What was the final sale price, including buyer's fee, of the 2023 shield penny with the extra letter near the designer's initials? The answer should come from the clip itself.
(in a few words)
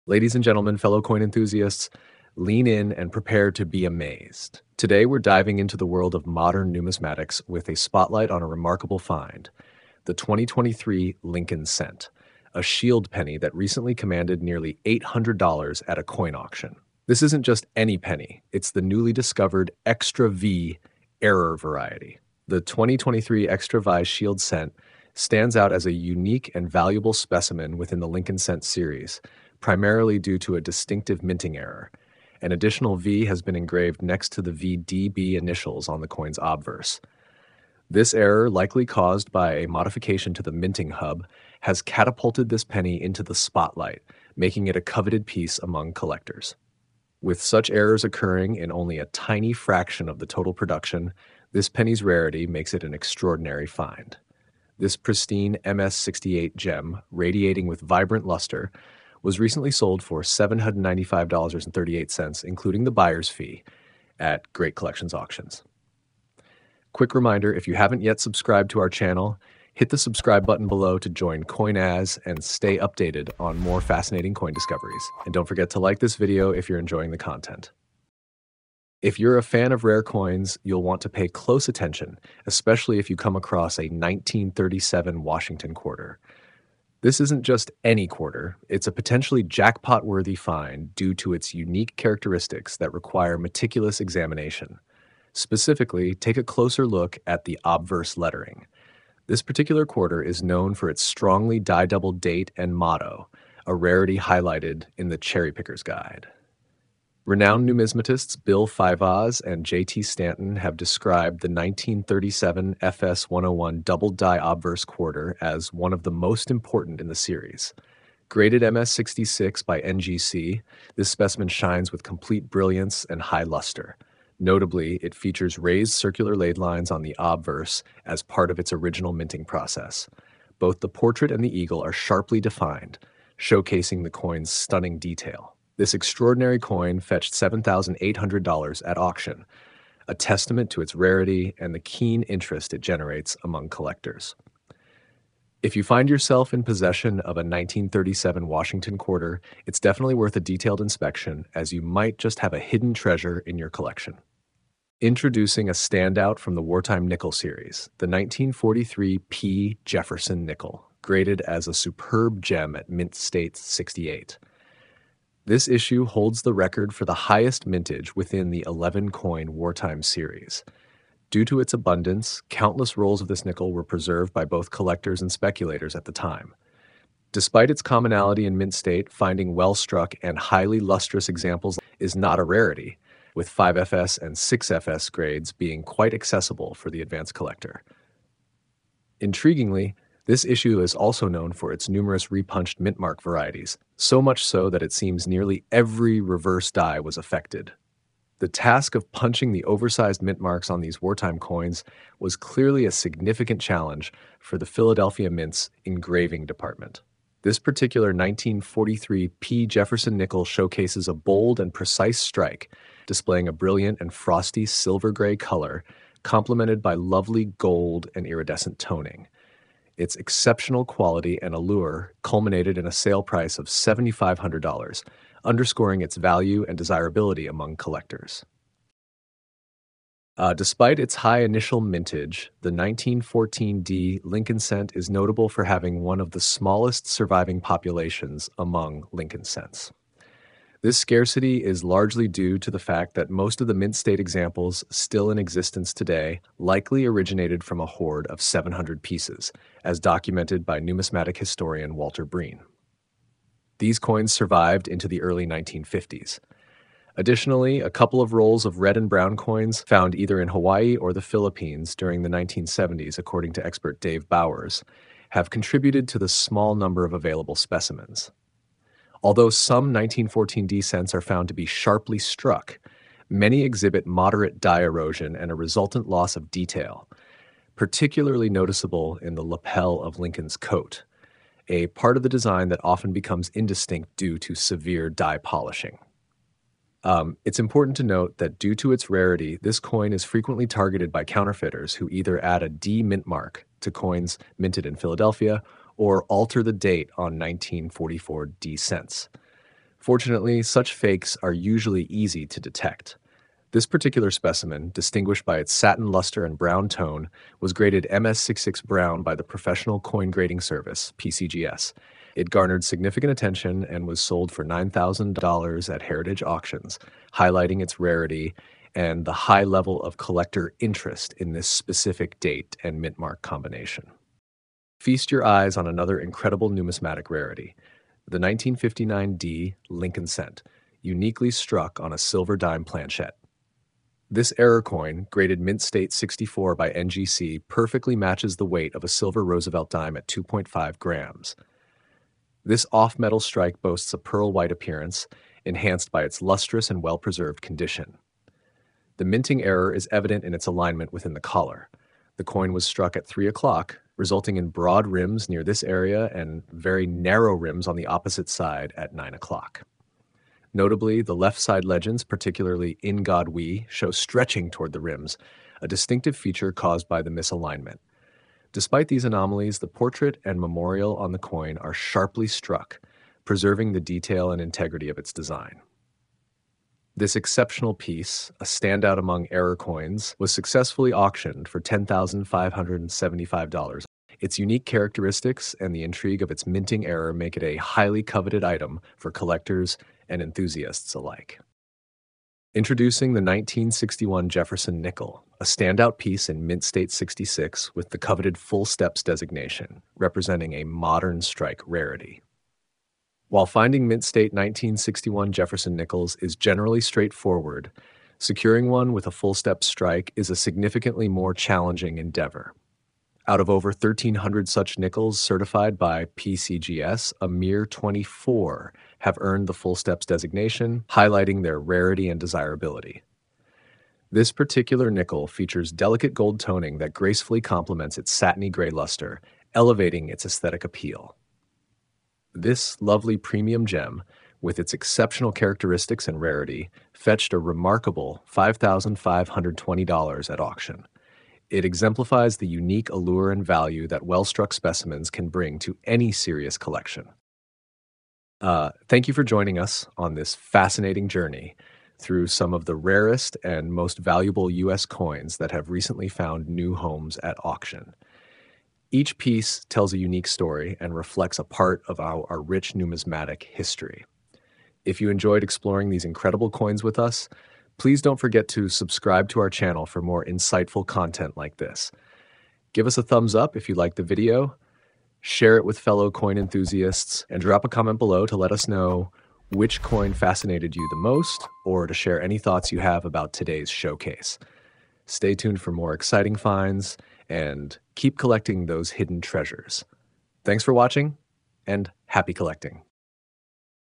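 $795.38.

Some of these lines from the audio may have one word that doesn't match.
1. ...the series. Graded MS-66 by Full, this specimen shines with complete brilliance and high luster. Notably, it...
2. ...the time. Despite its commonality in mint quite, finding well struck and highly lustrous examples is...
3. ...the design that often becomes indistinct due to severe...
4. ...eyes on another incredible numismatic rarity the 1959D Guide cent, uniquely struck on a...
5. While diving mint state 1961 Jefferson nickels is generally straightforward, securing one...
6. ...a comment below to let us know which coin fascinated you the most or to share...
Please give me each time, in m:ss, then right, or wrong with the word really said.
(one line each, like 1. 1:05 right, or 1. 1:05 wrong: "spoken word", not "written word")
1. 1:57 wrong: "NGC", not "Full"
2. 2:56 wrong: "state", not "quite"
3. 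4:42 right
4. 5:25 wrong: "Lincoln", not "Guide"
5. 6:43 wrong: "finding", not "diving"
6. 7:57 right.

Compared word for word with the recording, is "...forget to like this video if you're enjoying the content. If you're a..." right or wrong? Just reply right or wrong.
right.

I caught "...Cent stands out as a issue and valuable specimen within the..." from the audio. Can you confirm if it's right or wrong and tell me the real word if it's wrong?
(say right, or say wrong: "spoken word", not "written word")
wrong: "unique", not "issue".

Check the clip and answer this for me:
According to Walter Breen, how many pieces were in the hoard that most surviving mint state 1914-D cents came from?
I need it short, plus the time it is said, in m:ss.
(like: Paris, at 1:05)
700, at 4:08.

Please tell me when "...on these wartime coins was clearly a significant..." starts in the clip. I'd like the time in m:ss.
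3:20.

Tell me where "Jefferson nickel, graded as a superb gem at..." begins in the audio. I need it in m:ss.
2:39.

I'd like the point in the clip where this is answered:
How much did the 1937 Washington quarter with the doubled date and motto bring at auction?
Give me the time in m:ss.
2:17.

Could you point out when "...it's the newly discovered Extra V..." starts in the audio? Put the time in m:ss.
0:18.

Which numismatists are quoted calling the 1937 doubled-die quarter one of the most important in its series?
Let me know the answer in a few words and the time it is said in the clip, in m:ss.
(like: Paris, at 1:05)
Bill Fivaz and J.T. Stanton, at 1:48.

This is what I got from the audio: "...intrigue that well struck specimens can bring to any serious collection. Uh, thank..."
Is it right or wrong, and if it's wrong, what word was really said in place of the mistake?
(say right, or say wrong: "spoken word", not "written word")
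wrong: "value", not "intrigue".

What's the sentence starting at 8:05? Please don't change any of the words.
Stay tuned for more exciting finds and keep collecting those hidden treasures.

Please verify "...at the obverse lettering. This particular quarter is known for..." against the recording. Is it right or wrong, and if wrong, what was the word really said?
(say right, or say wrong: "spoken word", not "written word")
right.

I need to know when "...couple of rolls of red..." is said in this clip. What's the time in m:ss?
4:17.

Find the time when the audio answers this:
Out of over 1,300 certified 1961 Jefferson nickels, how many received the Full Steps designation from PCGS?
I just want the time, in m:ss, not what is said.
6:57.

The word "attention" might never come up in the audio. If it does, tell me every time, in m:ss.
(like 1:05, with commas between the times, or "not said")
1:21, 5:13.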